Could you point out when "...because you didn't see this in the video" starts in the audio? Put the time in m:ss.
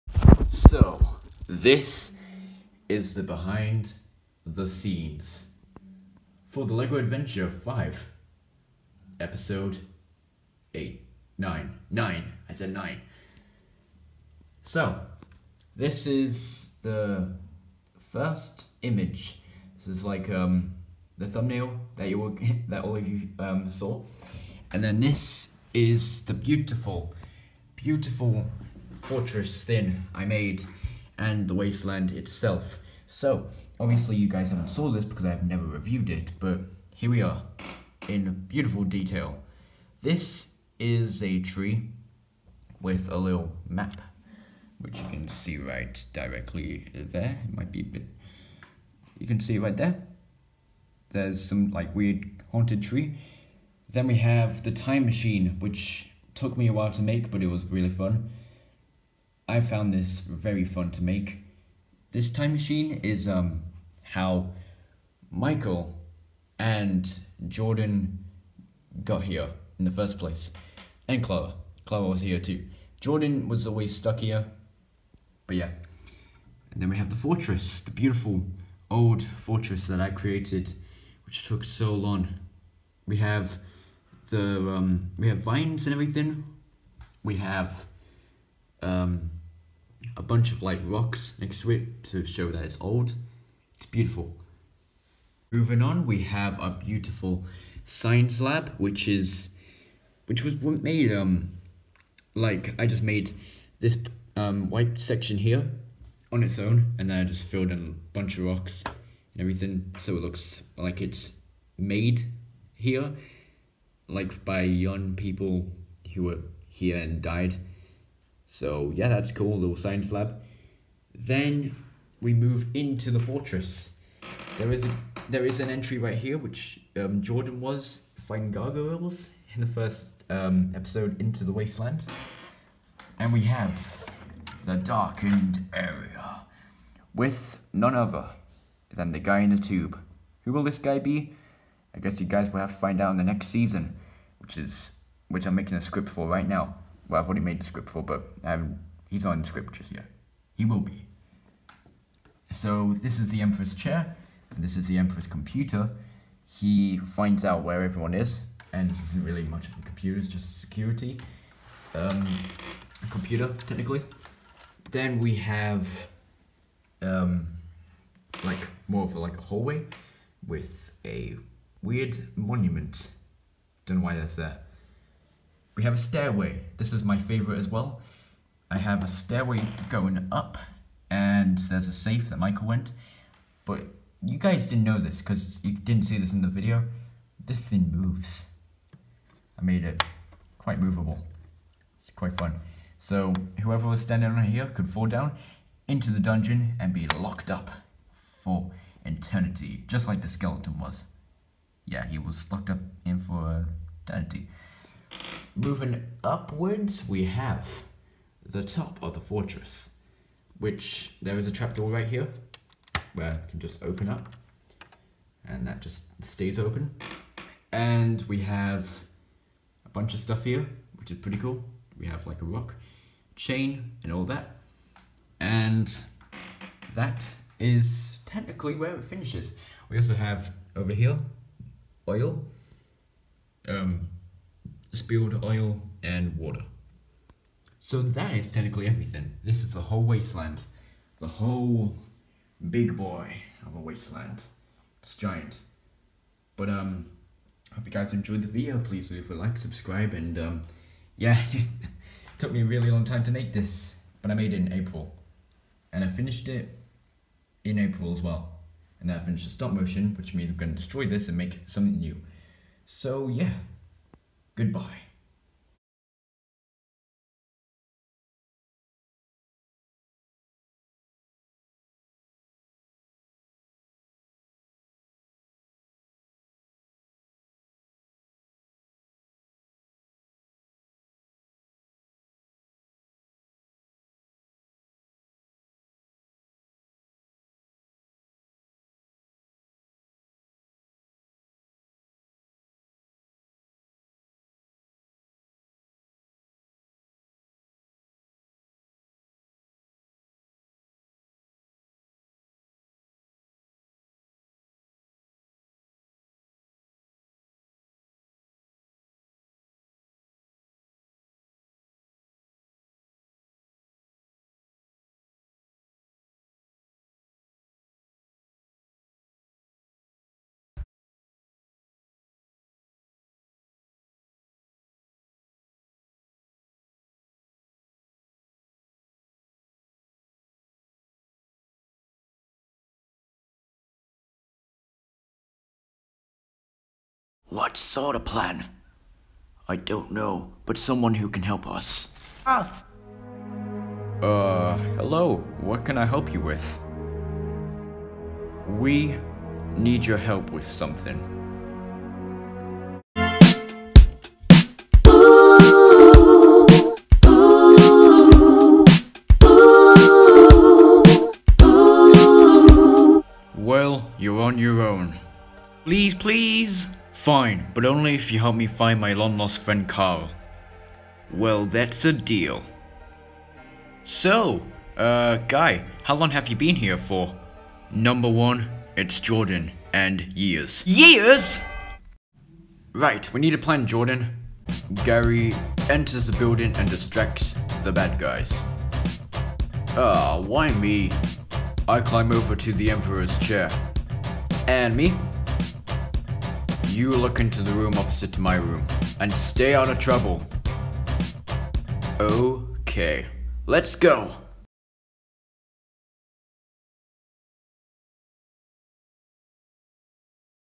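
3:05.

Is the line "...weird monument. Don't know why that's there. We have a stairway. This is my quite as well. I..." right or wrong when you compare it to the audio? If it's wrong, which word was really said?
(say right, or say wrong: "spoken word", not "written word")
wrong: "favorite", not "quite".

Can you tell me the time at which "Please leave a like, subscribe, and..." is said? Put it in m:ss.
4:08.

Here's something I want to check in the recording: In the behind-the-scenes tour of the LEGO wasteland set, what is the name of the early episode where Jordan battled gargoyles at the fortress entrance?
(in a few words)
Into the Wasteland.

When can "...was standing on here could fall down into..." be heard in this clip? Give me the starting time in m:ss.
3:13.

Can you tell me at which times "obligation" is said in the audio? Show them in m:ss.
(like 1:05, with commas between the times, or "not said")
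not said.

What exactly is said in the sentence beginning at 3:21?
Yeah, he was locked up in for eternity.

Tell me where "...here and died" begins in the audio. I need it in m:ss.
1:56.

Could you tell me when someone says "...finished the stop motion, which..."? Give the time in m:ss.
4:19.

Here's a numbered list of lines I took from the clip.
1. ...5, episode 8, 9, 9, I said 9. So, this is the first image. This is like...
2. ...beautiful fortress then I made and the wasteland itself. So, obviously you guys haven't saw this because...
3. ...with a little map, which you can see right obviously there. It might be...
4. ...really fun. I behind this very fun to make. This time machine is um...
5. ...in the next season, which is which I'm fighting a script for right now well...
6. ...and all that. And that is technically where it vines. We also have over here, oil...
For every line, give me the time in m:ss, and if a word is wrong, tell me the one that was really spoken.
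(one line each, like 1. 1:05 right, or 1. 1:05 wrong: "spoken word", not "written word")
1. 0:07 right
2. 0:27 right
3. 0:42 wrong: "directly", not "obviously"
4. 0:57 wrong: "found", not "behind"
5. 2:23 wrong: "making", not "fighting"
6. 3:44 wrong: "finishes", not "vines".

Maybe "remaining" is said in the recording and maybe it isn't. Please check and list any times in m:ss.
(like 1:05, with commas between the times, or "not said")
not said.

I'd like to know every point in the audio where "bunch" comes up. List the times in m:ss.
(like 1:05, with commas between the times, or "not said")
1:30, 1:48, 3:39.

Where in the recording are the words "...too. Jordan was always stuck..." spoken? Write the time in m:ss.
1:12.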